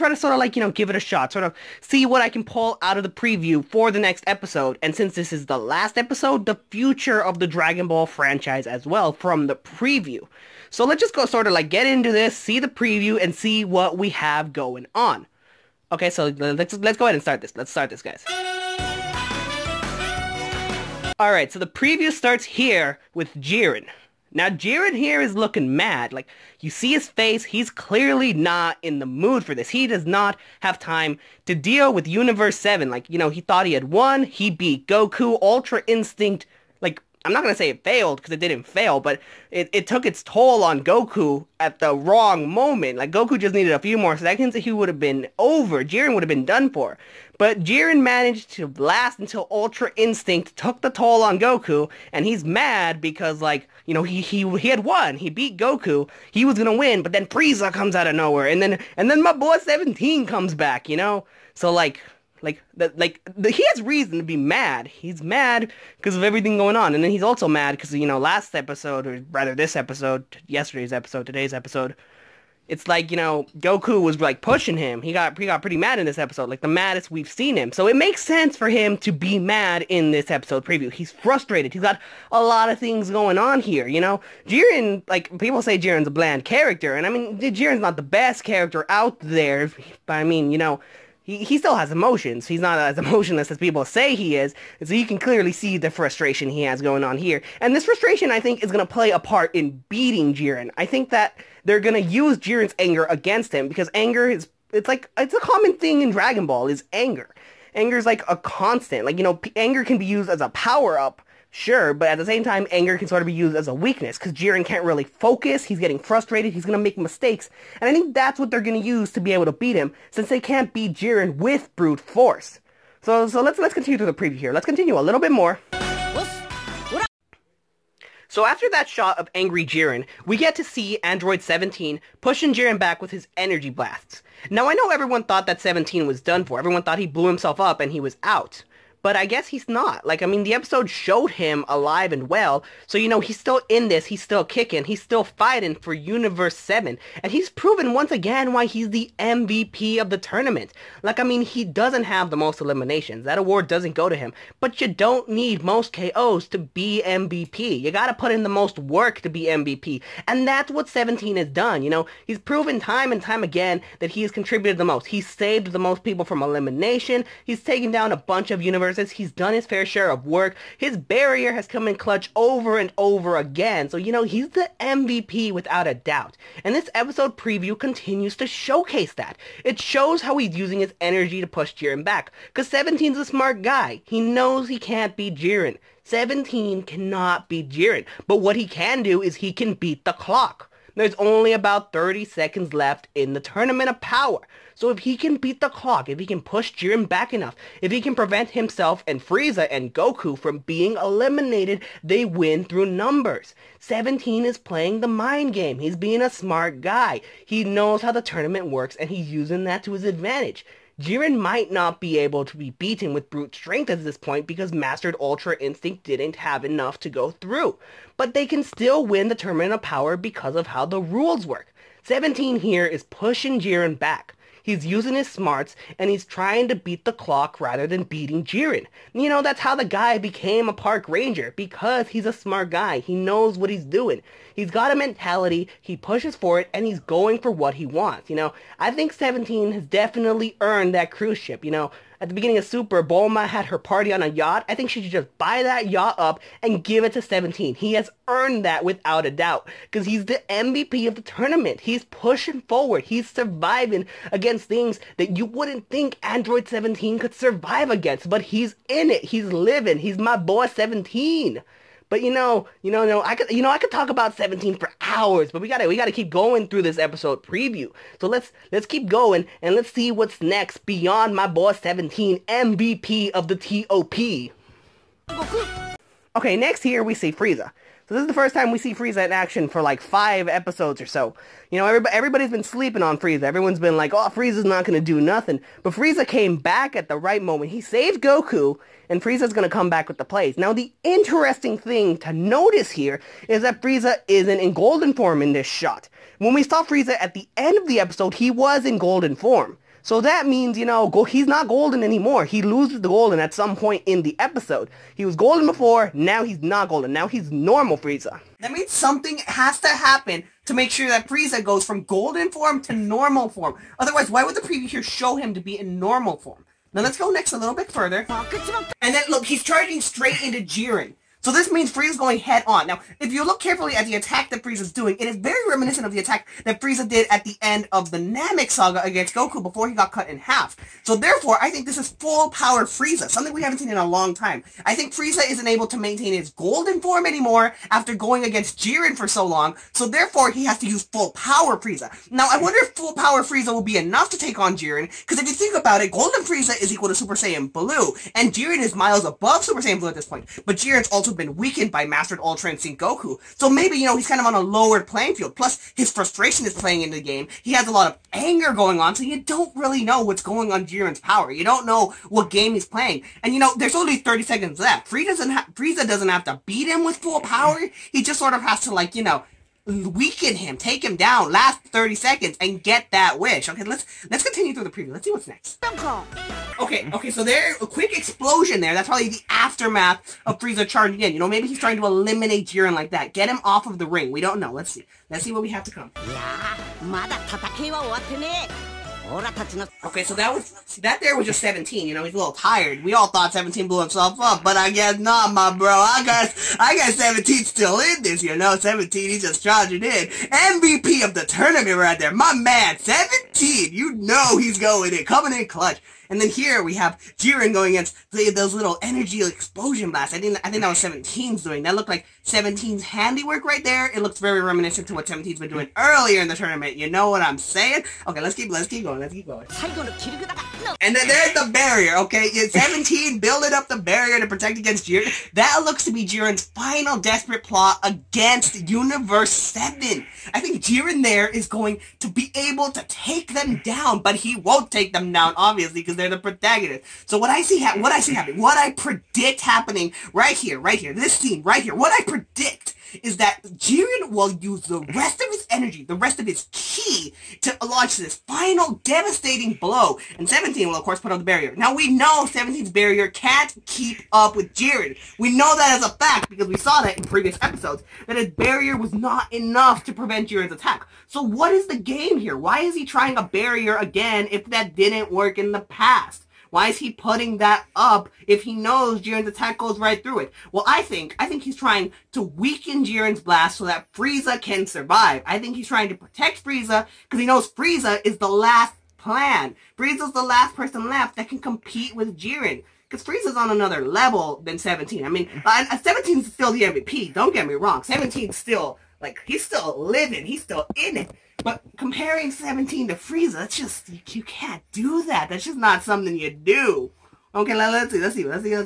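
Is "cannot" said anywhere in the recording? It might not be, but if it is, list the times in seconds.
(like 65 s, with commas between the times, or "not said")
186 s.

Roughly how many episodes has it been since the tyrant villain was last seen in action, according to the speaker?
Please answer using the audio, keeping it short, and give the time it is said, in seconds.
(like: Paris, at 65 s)
5, at 280 s.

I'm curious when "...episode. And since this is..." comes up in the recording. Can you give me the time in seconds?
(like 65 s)
4 s.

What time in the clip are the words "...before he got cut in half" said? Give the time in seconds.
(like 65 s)
329 s.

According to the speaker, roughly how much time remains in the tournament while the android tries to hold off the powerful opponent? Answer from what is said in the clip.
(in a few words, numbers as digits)
30 seconds.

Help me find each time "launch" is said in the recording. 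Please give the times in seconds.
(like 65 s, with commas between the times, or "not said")
447 s.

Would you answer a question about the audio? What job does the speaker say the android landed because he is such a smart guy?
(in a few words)
park ranger.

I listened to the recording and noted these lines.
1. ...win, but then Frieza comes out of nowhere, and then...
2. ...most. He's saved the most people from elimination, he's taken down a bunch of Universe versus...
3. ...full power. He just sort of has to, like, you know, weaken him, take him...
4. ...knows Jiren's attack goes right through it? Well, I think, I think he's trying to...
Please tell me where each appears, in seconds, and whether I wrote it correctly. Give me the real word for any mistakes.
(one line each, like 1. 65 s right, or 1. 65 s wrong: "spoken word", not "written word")
1. 56 s right
2. 164 s right
3. 367 s right
4. 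468 s right.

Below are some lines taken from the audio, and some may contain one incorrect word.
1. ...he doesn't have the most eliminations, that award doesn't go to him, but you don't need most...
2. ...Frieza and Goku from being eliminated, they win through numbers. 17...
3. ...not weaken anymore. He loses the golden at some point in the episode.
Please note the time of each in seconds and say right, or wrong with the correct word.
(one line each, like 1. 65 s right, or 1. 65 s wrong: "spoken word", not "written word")
1. 151 s right
2. 199 s right
3. 301 s wrong: "golden", not "weaken".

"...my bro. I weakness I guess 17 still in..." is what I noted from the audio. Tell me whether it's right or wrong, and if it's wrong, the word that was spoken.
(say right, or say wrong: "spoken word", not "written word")
wrong: "guess", not "weakness".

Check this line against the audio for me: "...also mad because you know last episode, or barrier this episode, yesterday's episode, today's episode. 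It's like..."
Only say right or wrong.
wrong.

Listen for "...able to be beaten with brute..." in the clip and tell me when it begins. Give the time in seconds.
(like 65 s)
212 s.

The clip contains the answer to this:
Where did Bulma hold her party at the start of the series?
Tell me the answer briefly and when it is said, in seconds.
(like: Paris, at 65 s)
a yacht, at 244 s.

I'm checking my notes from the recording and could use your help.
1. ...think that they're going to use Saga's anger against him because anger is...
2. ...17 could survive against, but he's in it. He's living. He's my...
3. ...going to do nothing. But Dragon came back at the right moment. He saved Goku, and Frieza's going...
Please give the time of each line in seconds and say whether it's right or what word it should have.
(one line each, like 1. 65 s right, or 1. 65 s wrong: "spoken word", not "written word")
1. 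100 s wrong: "Jiren", not "Saga"
2. 256 s right
3. 284 s wrong: "Frieza", not "Dragon".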